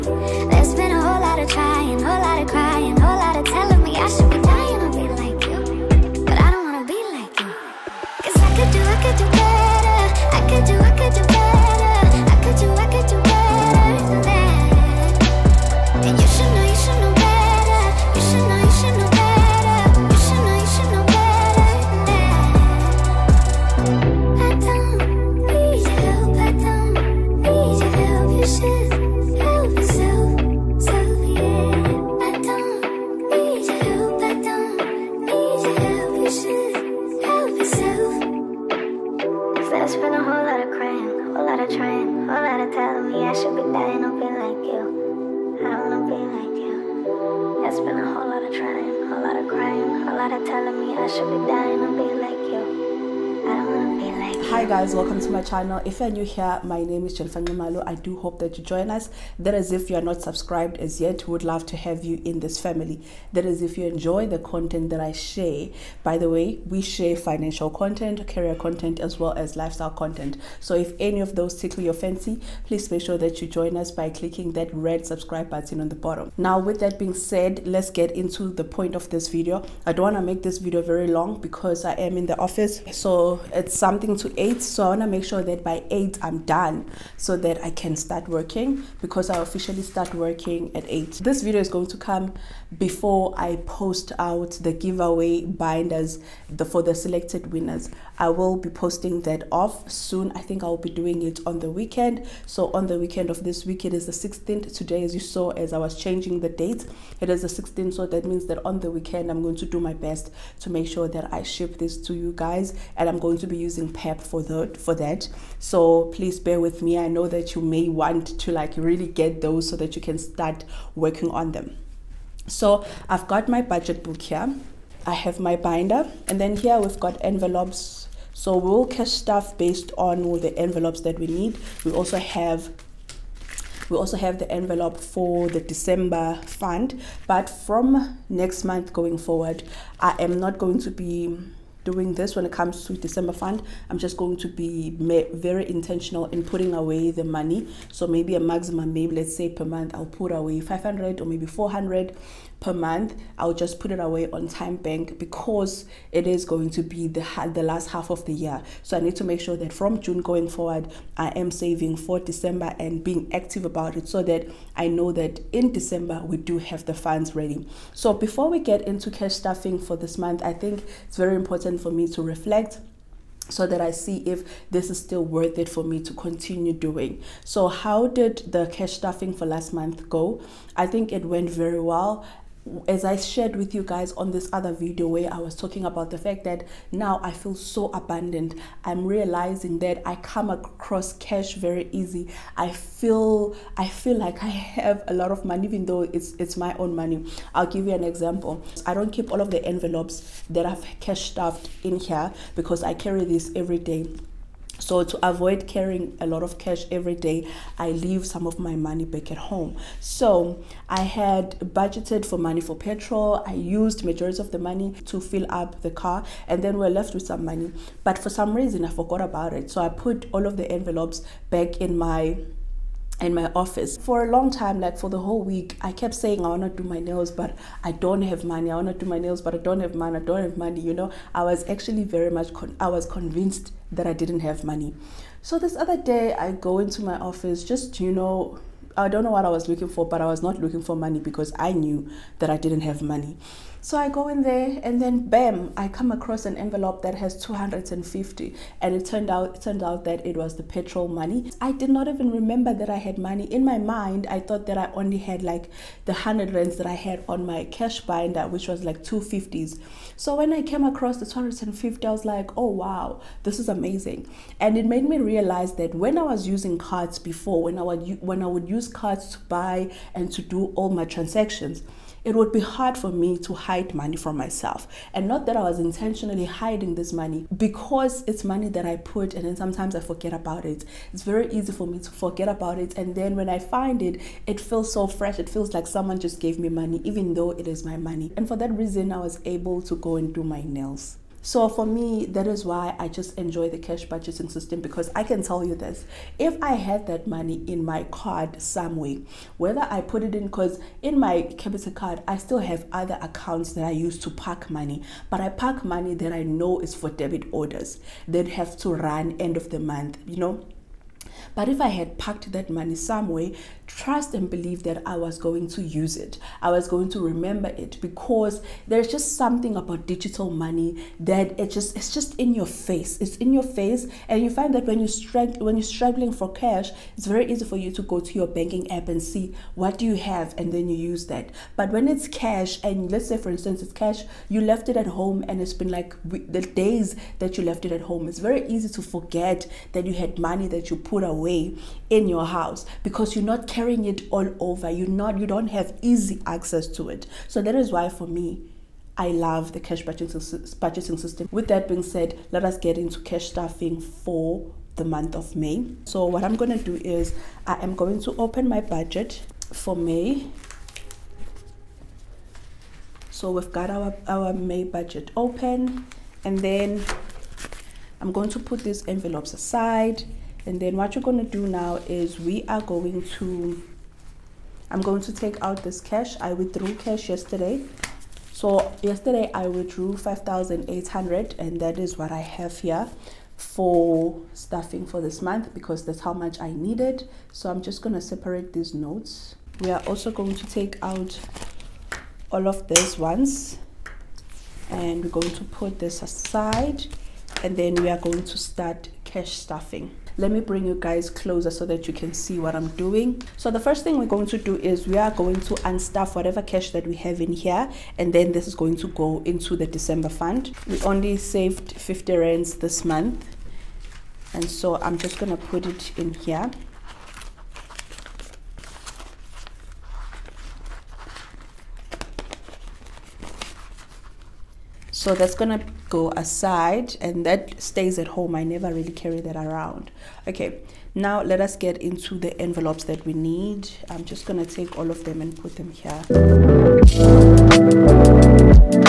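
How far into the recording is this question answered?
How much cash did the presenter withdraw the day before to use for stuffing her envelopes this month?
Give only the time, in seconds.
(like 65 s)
380 s.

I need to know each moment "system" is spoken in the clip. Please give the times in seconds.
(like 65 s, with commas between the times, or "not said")
294 s, 351 s.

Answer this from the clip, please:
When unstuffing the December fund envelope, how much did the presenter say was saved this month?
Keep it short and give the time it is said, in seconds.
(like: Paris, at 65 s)
50 rands, at 411 s.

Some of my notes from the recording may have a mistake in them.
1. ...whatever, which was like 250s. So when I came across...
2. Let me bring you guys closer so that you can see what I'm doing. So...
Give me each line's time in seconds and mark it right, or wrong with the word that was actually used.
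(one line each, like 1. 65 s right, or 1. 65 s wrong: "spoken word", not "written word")
1. 258 s wrong: "binder", not "whatever"
2. 400 s right.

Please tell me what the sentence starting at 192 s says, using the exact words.
I feel I feel like I have a lot of money even though it's it's my own money.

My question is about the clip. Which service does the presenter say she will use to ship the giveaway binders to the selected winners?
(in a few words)
PEP.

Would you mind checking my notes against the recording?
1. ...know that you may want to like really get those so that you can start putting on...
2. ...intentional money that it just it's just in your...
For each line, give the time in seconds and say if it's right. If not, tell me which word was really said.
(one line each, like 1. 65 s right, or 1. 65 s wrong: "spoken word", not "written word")
1. 117 s wrong: "working", not "putting"
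2. 320 s wrong: "digital", not "intentional".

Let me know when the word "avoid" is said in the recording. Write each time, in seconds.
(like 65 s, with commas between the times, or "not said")
205 s.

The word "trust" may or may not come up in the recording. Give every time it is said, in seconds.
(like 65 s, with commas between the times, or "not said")
313 s.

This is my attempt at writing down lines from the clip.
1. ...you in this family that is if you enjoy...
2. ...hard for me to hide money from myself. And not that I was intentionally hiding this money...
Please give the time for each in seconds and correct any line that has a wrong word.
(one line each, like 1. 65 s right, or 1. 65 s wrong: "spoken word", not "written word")
1. 62 s right
2. 272 s right.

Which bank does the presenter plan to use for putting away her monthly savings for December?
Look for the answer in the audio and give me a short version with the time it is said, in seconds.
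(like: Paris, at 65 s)
TymeBank, at 154 s.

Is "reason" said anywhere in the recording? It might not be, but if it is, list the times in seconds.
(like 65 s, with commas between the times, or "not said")
218 s, 288 s.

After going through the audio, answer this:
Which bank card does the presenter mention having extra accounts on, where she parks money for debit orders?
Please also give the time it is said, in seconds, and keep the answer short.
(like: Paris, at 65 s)
Capitec, at 301 s.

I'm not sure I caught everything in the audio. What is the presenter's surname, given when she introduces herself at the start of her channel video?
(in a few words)
Nxumalo.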